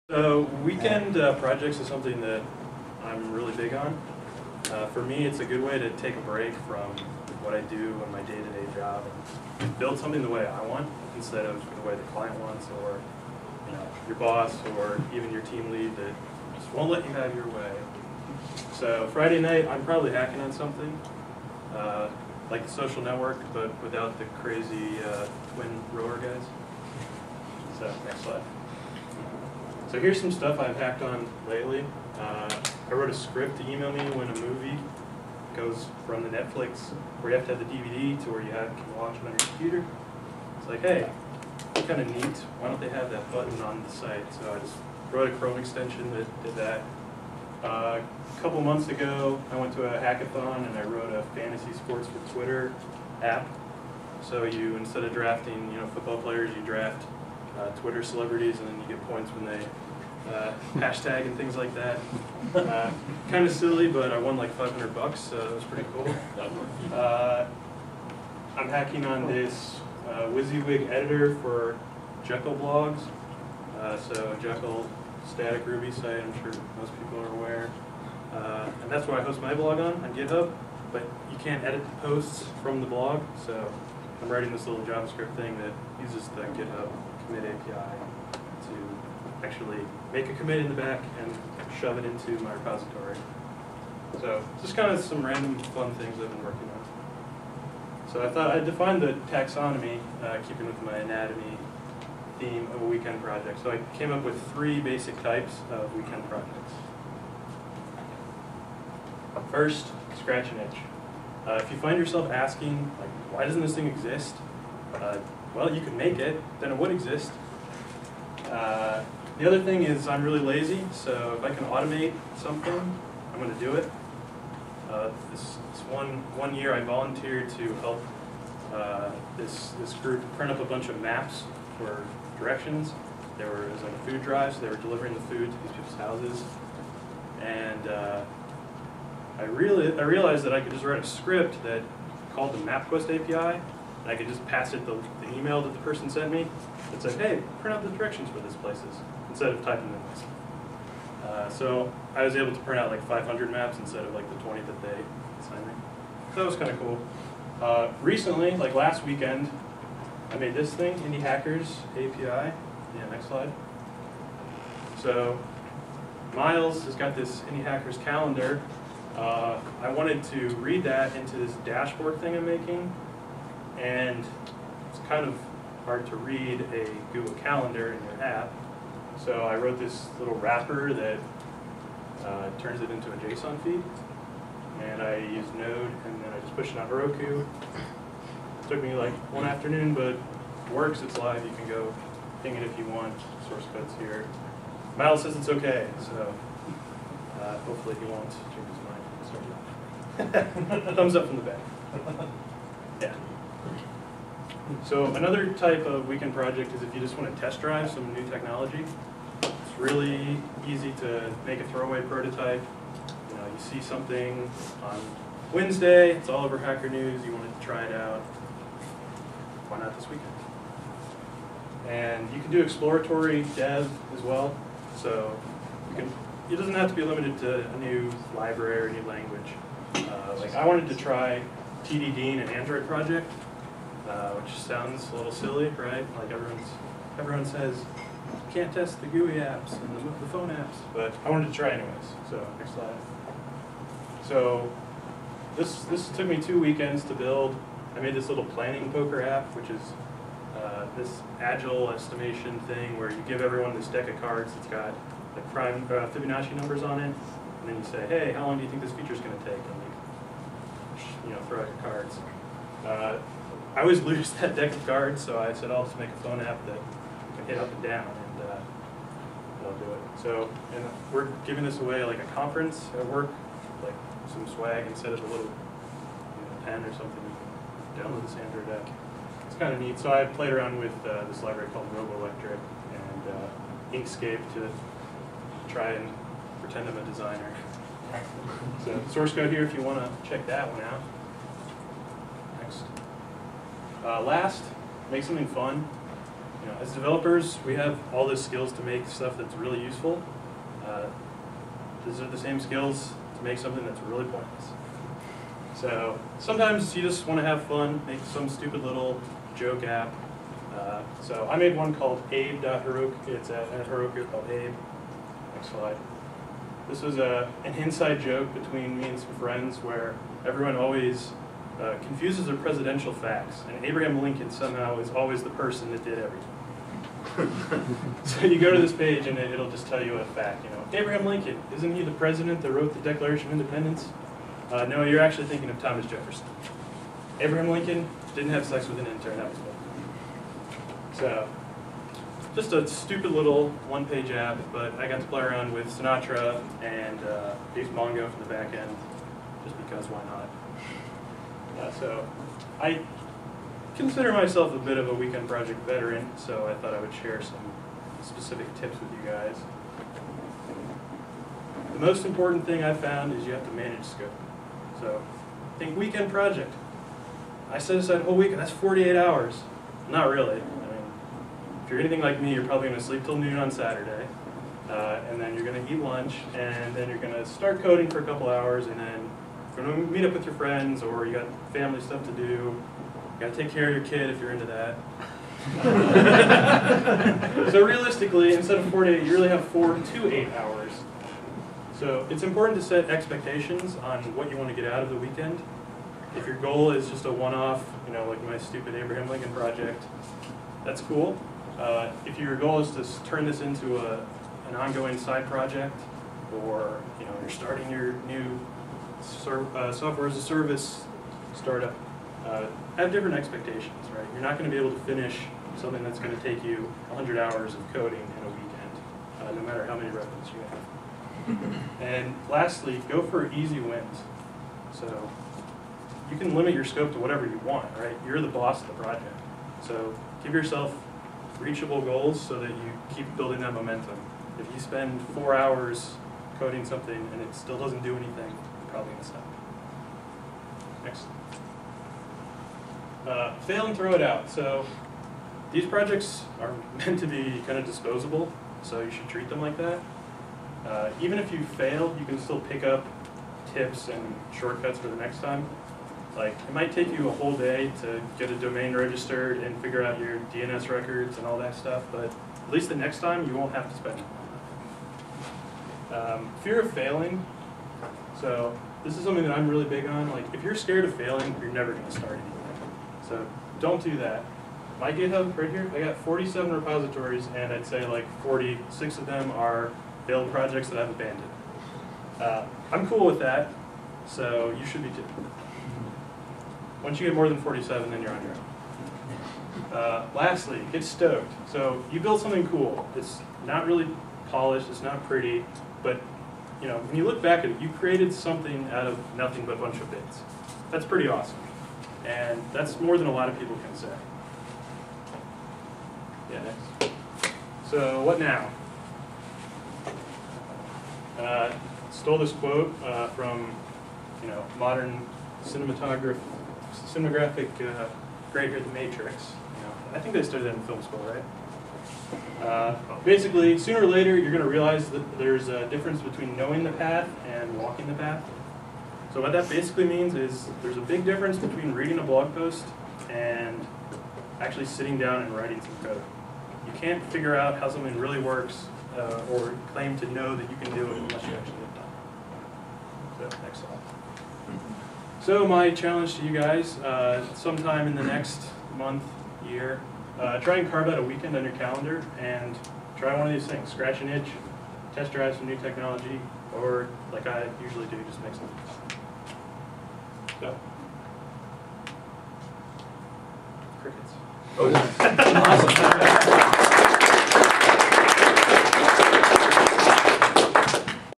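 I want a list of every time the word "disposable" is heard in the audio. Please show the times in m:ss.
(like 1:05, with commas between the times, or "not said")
7:27.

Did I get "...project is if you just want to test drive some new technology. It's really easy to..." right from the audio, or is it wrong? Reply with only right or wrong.
right.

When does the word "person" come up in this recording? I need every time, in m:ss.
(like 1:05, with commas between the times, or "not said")
2:25, 5:25.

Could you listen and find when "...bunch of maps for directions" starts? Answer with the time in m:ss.
2:10.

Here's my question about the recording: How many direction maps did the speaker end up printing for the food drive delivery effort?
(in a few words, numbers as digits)
500.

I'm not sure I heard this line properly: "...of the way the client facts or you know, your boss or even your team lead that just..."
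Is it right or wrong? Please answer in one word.
wrong.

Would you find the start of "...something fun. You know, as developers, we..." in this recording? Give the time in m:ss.
4:55.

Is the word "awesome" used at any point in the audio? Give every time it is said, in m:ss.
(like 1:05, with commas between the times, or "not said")
8:21, 9:25.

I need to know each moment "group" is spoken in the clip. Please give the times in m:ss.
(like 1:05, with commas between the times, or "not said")
2:09.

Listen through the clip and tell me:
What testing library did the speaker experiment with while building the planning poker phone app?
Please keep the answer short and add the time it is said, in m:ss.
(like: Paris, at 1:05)
Robolectric, at 4:41.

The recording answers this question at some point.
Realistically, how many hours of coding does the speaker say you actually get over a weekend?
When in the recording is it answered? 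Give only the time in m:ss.
6:29.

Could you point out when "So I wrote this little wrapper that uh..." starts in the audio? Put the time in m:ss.
2:59.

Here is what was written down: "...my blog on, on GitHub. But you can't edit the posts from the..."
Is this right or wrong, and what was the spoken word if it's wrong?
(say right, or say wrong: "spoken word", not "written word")
right.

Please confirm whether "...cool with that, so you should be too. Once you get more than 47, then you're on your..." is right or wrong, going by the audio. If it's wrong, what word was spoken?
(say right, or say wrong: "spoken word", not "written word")
right.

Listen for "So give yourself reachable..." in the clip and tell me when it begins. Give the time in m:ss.
7:09.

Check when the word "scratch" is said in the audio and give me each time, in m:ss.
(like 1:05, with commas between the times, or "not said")
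1:50, 9:13.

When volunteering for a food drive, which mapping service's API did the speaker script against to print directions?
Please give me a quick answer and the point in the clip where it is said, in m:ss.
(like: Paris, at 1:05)
MapQuest, at 2:22.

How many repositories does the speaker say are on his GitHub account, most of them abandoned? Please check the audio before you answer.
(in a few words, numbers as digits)
47.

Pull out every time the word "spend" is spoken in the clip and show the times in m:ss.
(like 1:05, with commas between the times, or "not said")
7:14, 7:43.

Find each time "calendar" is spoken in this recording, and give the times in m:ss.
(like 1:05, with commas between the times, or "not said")
2:47, 2:57, 9:11.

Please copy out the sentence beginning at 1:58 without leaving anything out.
Uh, the other thing is I'm really lazy, so if I can automate something, I'm going to do it.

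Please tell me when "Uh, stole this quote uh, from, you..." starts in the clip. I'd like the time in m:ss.
8:31.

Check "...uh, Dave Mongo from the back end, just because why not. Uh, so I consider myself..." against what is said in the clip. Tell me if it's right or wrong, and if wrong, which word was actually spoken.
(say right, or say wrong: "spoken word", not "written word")
right.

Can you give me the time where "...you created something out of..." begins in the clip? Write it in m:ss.
8:17.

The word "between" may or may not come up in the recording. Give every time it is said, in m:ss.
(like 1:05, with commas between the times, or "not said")
5:18, 8:46, 8:51.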